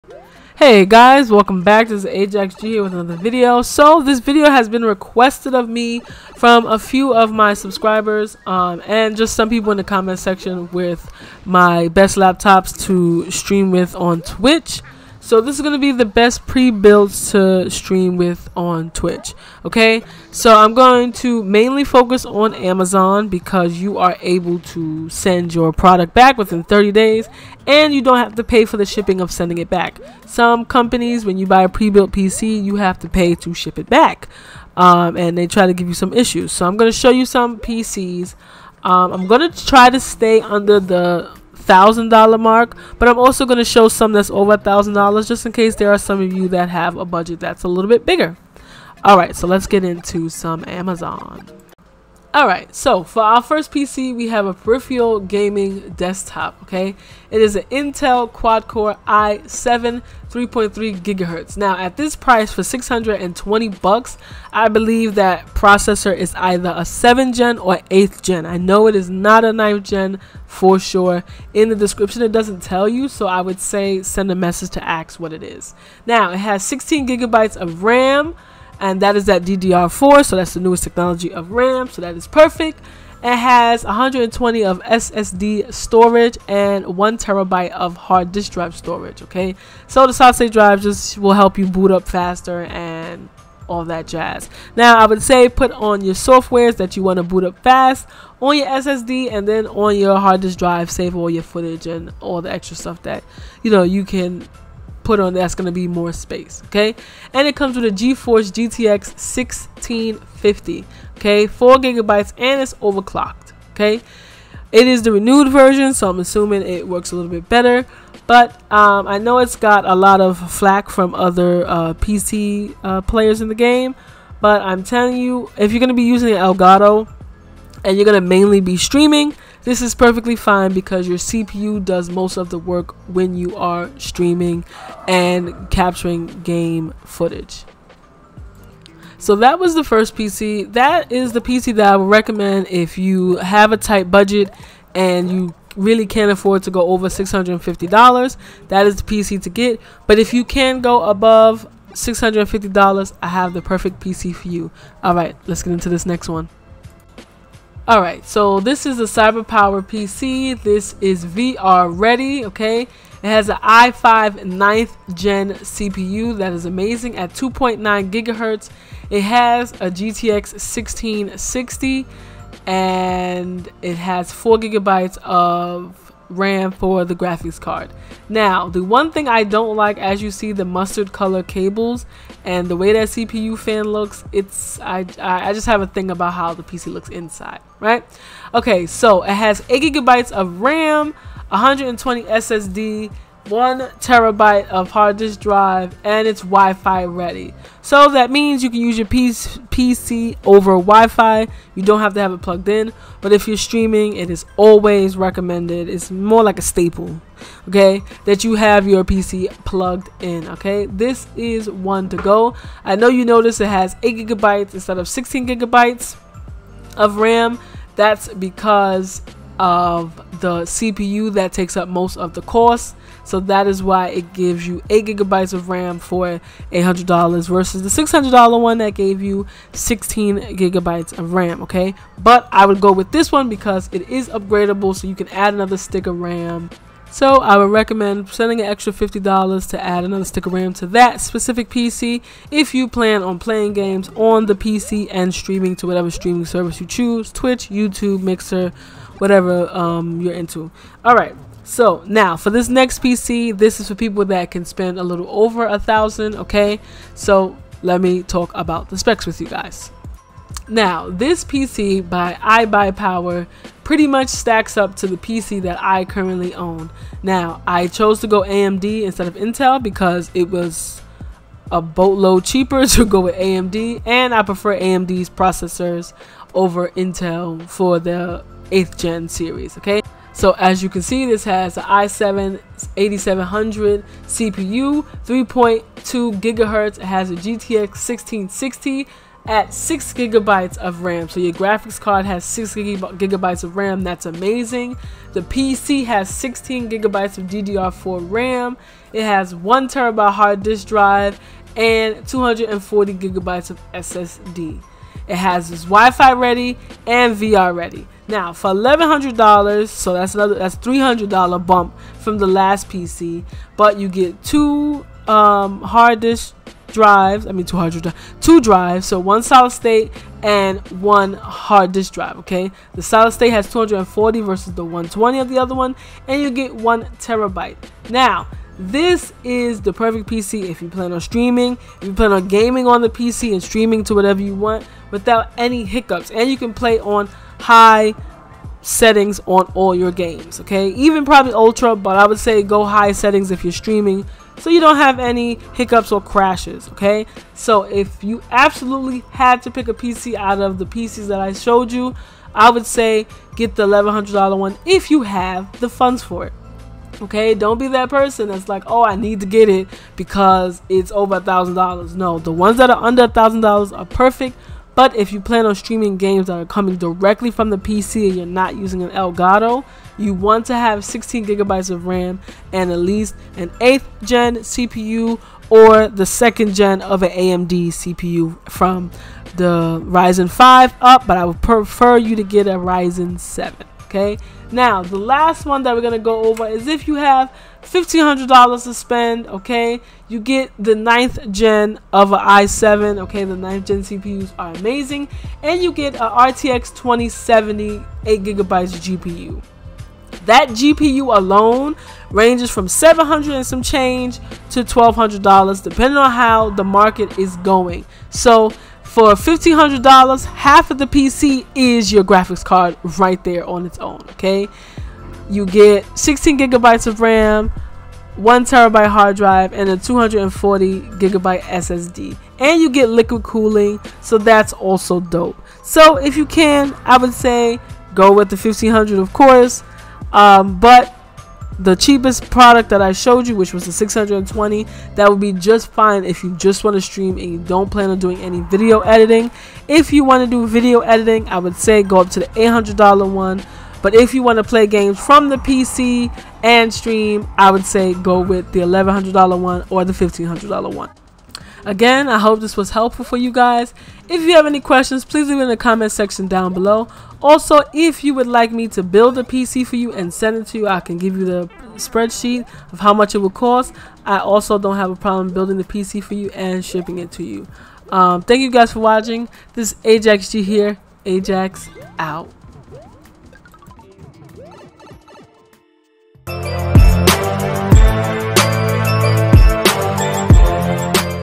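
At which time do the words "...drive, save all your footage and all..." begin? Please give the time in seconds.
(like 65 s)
100 s.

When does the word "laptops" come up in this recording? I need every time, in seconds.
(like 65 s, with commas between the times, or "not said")
12 s.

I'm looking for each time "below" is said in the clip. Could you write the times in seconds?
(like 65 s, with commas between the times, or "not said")
456 s.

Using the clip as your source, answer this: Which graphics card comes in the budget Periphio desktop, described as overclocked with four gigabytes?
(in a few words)
GTX 1650.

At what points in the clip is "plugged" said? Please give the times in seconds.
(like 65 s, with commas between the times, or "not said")
202 s, 209 s.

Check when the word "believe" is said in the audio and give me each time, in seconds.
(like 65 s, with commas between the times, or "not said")
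64 s.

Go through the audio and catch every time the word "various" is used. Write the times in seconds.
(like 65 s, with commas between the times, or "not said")
not said.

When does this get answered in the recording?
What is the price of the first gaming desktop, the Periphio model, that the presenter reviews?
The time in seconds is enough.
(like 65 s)
62 s.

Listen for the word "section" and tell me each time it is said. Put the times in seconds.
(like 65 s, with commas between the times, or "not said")
10 s, 456 s.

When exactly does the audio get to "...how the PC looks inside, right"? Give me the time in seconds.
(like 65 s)
186 s.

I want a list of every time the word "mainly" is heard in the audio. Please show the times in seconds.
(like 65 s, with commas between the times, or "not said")
21 s, 128 s.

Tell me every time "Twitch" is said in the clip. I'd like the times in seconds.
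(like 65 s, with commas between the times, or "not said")
14 s, 18 s, 247 s.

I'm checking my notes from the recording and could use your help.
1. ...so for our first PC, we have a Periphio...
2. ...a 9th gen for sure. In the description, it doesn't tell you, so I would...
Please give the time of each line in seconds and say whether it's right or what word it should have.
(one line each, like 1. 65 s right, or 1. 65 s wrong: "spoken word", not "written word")
1. 52 s right
2. 69 s right.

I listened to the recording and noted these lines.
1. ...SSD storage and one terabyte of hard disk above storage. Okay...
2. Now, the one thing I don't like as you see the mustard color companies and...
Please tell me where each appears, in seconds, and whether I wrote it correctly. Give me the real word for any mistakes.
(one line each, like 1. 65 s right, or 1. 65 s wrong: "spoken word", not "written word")
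1. 84 s wrong: "drive", not "above"
2. 178 s wrong: "cables", not "companies".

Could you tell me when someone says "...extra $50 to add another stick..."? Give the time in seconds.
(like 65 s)
238 s.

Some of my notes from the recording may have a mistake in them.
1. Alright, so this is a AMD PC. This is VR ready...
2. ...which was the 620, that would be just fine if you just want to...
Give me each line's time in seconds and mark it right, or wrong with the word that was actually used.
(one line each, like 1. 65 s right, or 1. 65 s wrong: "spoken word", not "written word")
1. 157 s wrong: "CyberPower", not "AMD"
2. 433 s right.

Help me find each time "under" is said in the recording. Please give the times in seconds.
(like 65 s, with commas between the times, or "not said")
40 s, 363 s.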